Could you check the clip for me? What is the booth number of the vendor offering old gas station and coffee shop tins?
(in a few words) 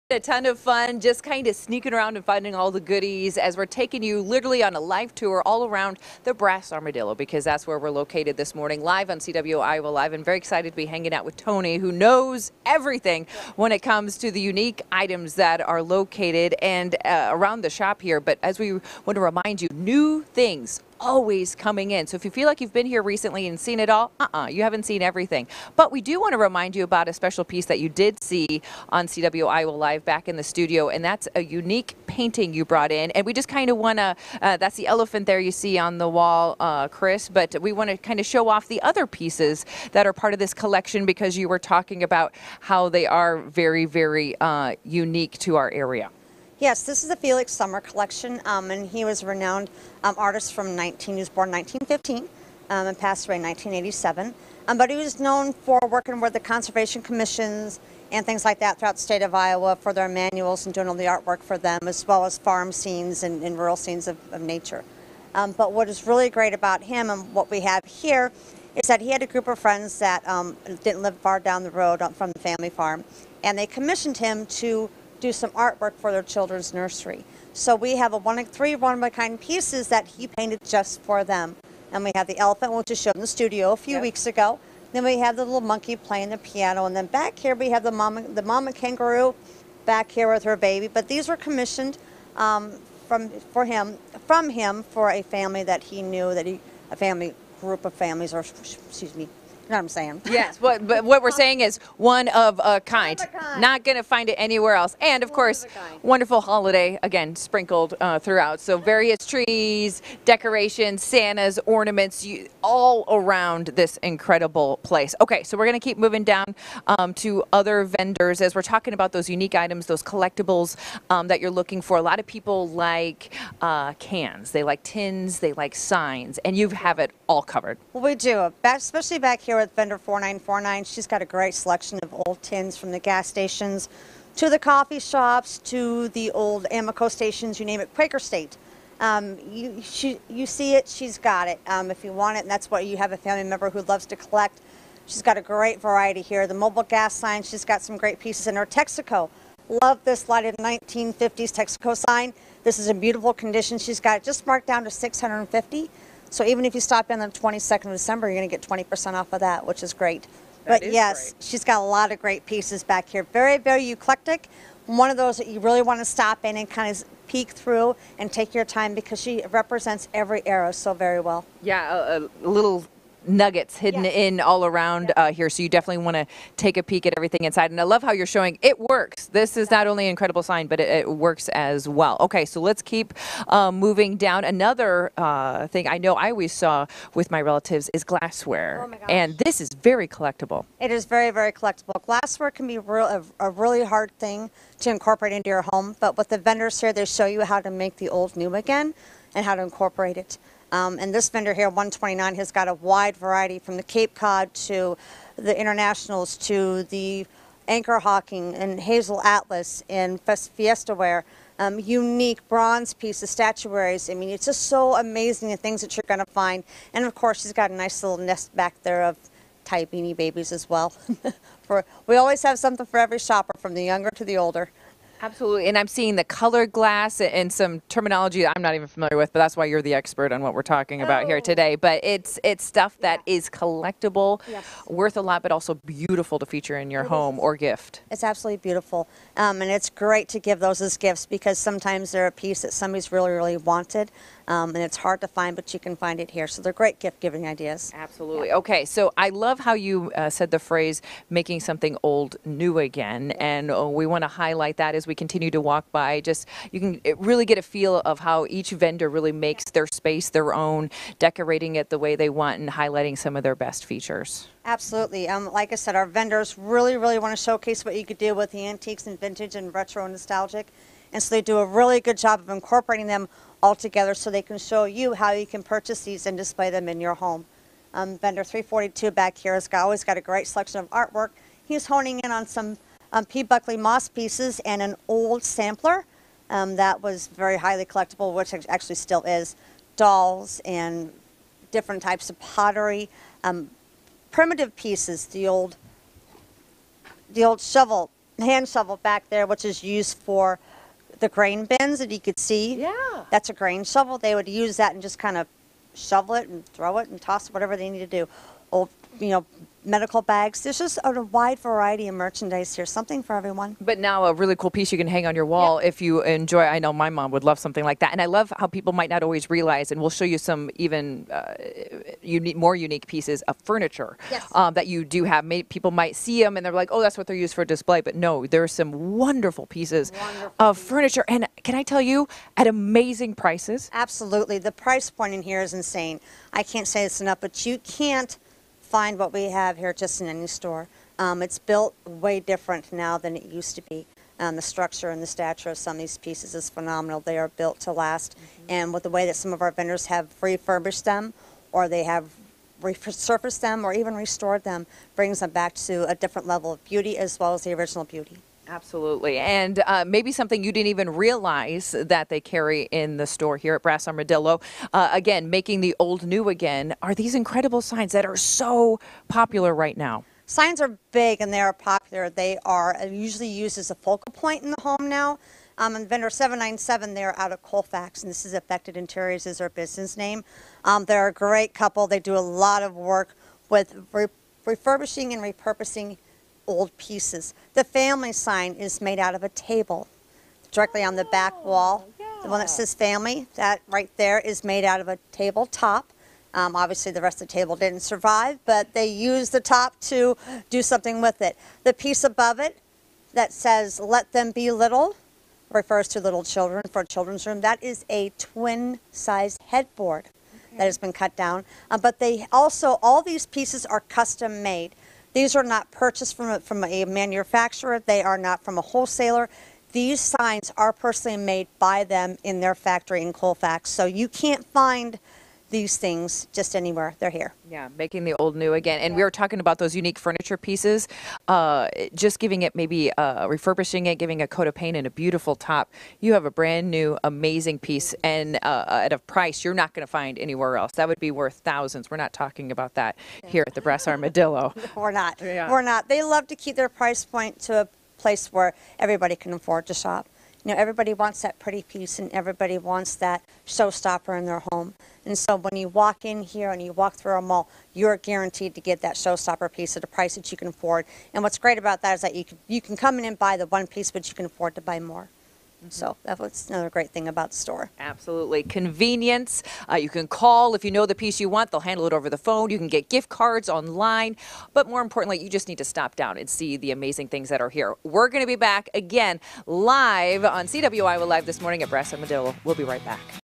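4949.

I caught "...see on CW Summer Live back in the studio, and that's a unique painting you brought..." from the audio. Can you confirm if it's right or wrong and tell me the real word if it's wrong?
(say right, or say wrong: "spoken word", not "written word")
wrong: "Iowa", not "Summer".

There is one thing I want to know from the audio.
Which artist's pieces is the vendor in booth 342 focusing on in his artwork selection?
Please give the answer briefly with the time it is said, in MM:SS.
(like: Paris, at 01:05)
P. Buckley Moss, at 04:43.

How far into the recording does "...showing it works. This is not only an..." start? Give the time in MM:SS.
02:58.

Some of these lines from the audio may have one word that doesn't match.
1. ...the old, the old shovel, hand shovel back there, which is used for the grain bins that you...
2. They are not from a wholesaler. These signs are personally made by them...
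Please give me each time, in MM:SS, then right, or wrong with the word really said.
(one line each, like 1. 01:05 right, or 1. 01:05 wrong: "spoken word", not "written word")
1. 04:55 right
2. 06:57 right.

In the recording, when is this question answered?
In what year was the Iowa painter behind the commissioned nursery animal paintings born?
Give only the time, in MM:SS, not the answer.
00:51.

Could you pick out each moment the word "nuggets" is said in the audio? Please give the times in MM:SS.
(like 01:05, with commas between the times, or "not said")
02:53.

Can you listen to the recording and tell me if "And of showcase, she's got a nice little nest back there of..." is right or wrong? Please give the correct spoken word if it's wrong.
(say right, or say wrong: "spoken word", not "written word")
wrong: "course", not "showcase".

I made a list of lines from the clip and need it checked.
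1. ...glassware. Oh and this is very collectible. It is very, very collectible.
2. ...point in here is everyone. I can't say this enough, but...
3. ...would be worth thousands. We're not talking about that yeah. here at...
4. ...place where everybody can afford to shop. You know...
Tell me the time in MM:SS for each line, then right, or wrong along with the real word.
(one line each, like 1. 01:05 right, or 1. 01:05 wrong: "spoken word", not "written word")
1. 03:08 right
2. 05:35 wrong: "insane", not "everyone"
3. 07:21 right
4. 07:28 right.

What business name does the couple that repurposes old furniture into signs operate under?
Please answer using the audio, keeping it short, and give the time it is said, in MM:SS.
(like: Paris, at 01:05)
Affected Interiors, at 06:18.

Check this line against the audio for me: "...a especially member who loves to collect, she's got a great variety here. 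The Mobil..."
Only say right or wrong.
wrong.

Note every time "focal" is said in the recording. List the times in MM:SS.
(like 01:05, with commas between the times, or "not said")
06:13.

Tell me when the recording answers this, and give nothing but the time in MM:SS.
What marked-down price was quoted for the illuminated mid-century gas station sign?
02:34.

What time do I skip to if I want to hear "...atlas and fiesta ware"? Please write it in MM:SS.
03:29.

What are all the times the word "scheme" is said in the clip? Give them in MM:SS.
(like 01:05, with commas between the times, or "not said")
not said.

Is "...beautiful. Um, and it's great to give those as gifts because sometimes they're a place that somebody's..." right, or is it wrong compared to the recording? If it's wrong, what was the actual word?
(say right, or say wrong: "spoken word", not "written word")
wrong: "piece", not "place".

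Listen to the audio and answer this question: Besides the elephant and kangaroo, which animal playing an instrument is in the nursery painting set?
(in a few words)
Monkey.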